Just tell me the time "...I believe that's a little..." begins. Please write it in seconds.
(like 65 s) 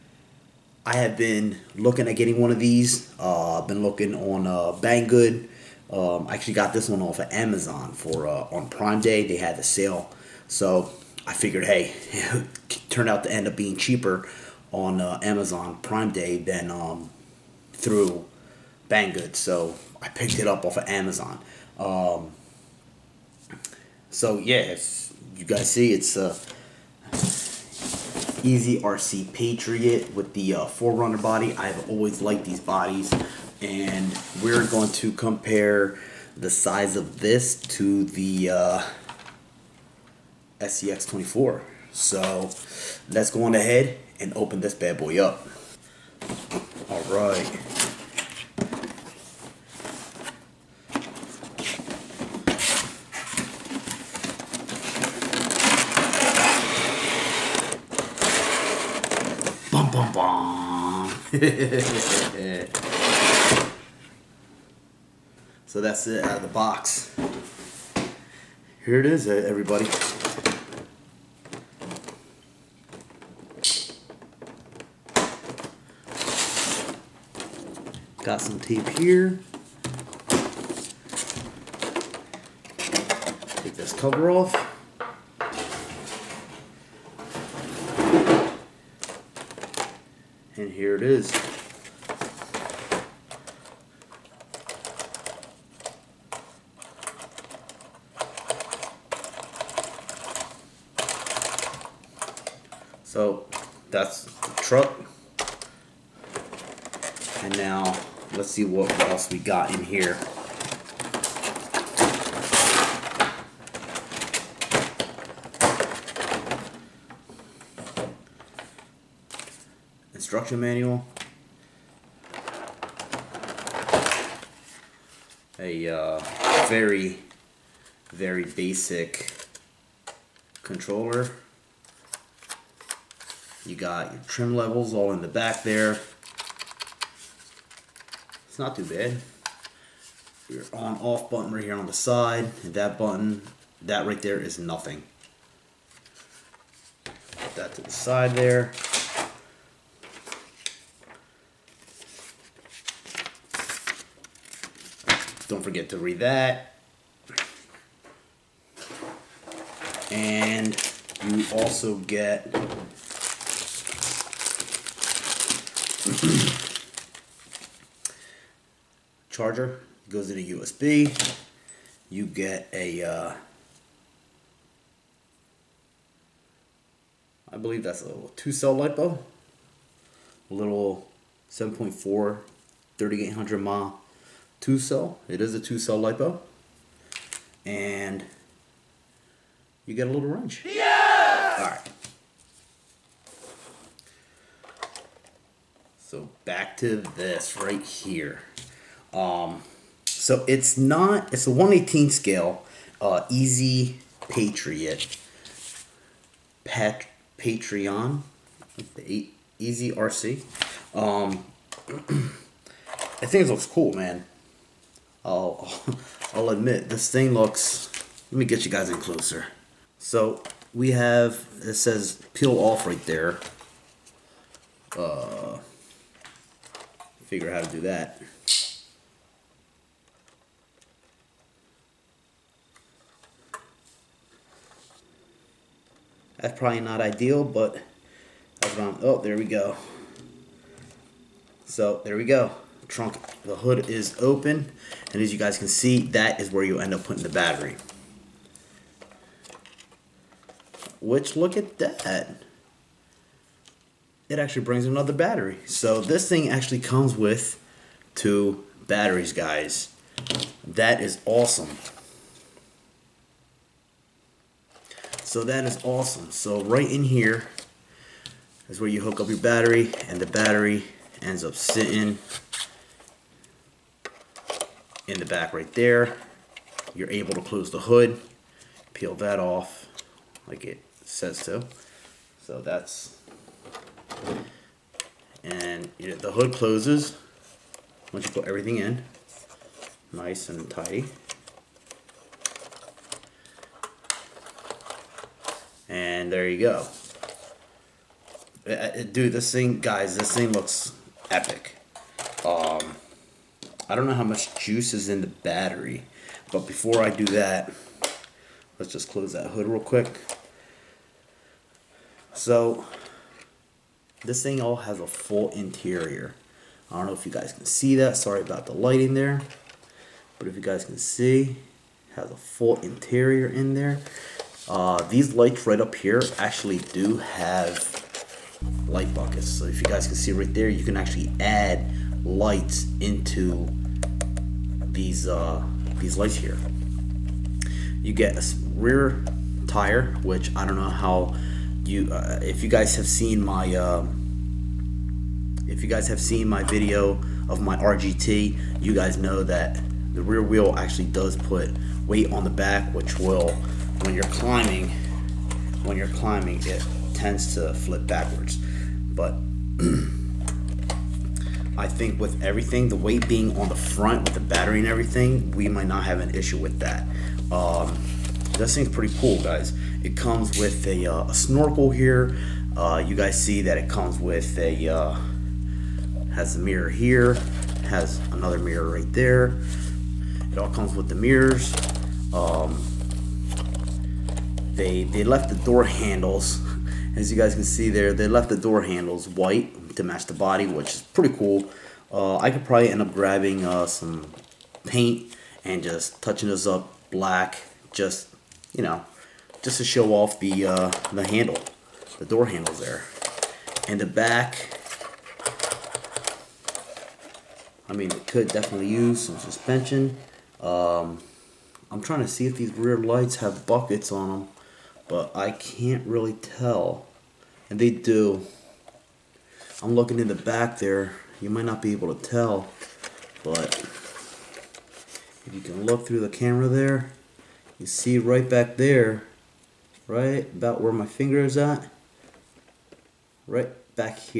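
177 s.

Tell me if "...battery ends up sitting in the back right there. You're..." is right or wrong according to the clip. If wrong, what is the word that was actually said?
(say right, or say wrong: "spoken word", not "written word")
right.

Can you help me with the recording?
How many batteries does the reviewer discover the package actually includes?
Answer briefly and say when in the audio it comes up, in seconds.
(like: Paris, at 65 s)
2, at 258 s.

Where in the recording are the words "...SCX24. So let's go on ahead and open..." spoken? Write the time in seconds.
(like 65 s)
40 s.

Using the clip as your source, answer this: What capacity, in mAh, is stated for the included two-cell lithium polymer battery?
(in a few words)
3800 mAh.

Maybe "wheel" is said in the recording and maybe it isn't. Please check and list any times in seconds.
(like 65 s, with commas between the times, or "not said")
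350 s.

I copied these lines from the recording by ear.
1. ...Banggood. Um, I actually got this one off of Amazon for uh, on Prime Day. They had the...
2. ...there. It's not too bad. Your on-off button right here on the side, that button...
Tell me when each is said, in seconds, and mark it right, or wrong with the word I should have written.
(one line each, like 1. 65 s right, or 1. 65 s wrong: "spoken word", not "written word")
1. 4 s right
2. 135 s right.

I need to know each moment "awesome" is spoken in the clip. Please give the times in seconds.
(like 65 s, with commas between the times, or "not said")
261 s, 265 s.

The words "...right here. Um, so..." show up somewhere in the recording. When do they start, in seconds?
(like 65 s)
197 s.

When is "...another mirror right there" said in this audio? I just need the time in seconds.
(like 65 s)
378 s.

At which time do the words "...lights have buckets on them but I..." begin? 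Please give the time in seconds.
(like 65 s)
412 s.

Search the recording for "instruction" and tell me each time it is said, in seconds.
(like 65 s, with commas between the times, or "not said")
120 s.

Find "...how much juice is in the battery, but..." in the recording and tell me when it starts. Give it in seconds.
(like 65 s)
304 s.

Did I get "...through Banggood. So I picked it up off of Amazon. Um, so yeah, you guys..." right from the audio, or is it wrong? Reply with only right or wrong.
right.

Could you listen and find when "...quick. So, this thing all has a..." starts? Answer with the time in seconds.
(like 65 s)
309 s.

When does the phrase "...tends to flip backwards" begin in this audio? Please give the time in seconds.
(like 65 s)
357 s.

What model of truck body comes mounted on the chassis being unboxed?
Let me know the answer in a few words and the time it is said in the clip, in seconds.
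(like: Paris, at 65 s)
Forerunner, at 30 s.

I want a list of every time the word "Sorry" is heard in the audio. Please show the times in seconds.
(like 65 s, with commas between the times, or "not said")
318 s.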